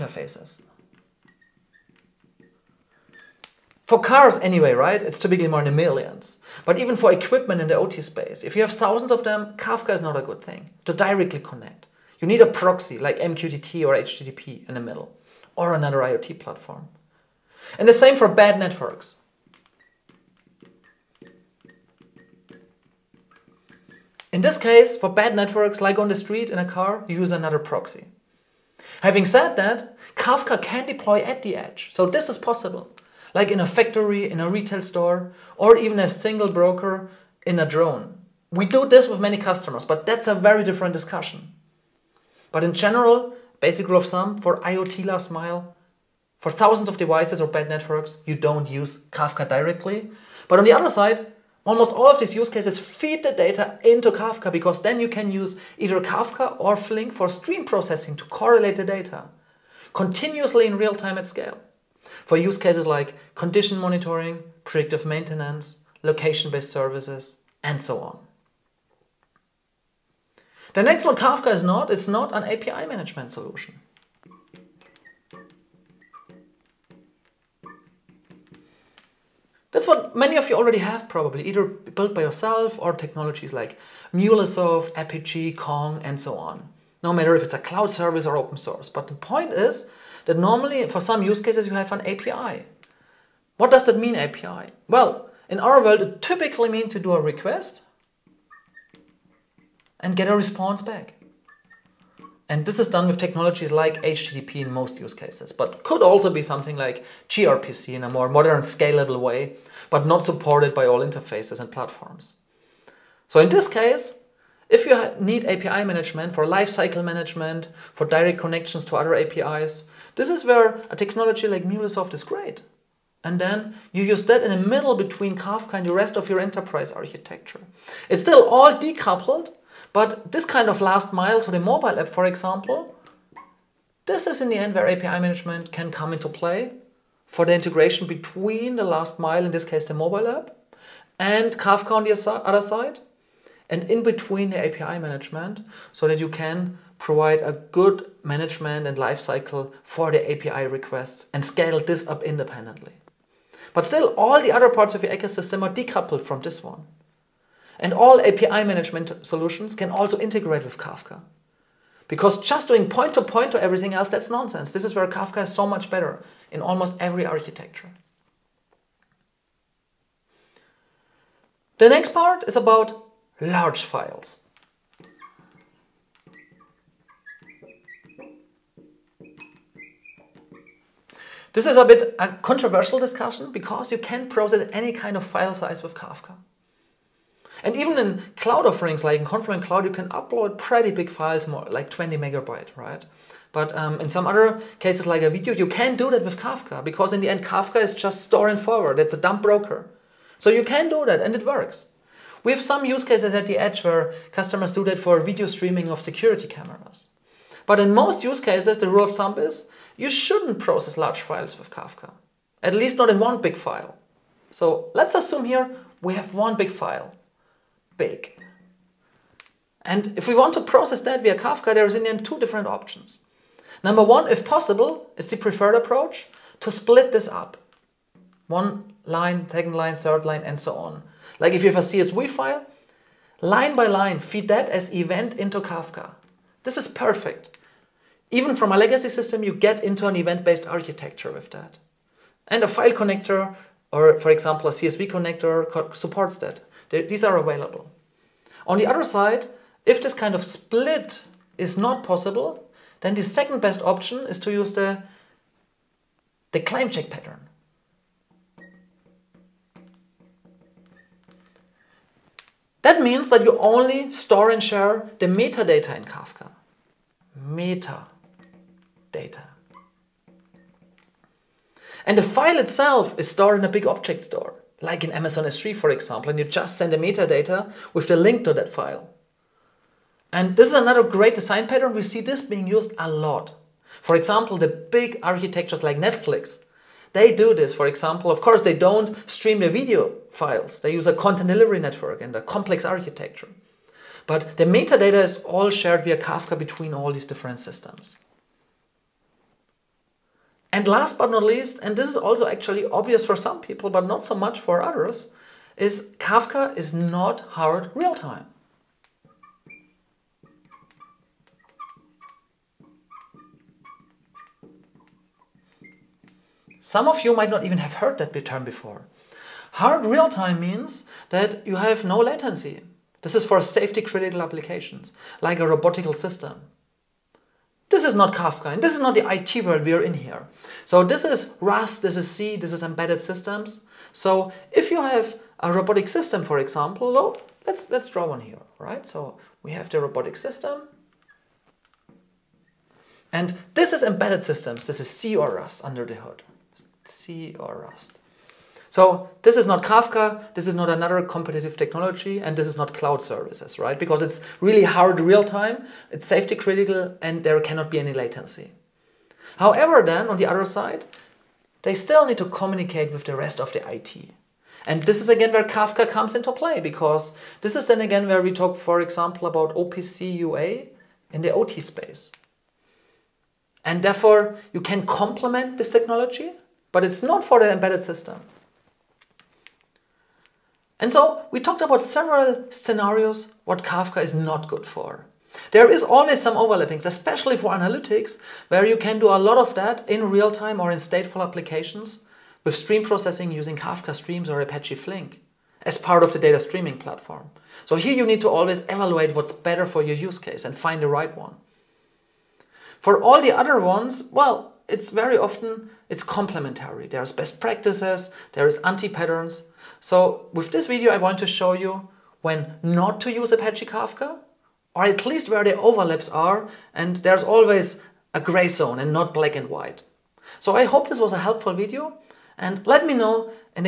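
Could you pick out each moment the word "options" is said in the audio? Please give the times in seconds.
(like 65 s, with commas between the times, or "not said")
222 s, 253 s.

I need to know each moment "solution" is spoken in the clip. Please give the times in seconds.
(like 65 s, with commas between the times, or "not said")
73 s, 159 s.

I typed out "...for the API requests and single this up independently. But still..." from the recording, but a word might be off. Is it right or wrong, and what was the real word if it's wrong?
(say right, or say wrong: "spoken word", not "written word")
wrong: "scale", not "single".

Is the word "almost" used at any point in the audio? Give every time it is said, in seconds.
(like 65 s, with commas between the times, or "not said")
51 s, 166 s.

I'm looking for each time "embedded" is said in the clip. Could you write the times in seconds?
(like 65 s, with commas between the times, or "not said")
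332 s, 344 s, 377 s.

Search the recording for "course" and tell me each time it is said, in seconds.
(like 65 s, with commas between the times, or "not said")
288 s.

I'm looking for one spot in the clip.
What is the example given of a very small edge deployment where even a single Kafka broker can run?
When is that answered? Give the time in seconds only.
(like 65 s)
37 s.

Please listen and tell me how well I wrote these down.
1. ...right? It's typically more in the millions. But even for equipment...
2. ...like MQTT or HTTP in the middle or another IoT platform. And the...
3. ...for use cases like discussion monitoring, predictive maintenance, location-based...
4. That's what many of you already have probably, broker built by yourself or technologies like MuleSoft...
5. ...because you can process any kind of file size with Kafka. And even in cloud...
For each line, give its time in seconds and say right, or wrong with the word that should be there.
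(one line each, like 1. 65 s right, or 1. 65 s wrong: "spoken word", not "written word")
1. 4 s right
2. 12 s right
3. 62 s wrong: "condition", not "discussion"
4. 79 s wrong: "either", not "broker"
5. 183 s right.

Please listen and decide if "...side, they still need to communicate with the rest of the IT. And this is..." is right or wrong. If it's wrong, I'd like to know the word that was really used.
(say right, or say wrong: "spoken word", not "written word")
right.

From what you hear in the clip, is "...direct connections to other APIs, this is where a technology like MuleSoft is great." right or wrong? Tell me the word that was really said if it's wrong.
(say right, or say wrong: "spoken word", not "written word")
right.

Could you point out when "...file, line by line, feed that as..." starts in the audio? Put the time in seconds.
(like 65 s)
232 s.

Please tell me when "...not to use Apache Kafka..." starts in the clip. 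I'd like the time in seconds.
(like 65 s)
412 s.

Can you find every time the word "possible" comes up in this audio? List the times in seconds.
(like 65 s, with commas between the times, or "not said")
32 s, 224 s, 252 s.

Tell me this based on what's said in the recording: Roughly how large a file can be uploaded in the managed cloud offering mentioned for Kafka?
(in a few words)
20 megabytes.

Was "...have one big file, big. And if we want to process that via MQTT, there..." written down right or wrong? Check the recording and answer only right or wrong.
wrong.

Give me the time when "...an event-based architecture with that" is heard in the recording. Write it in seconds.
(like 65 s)
240 s.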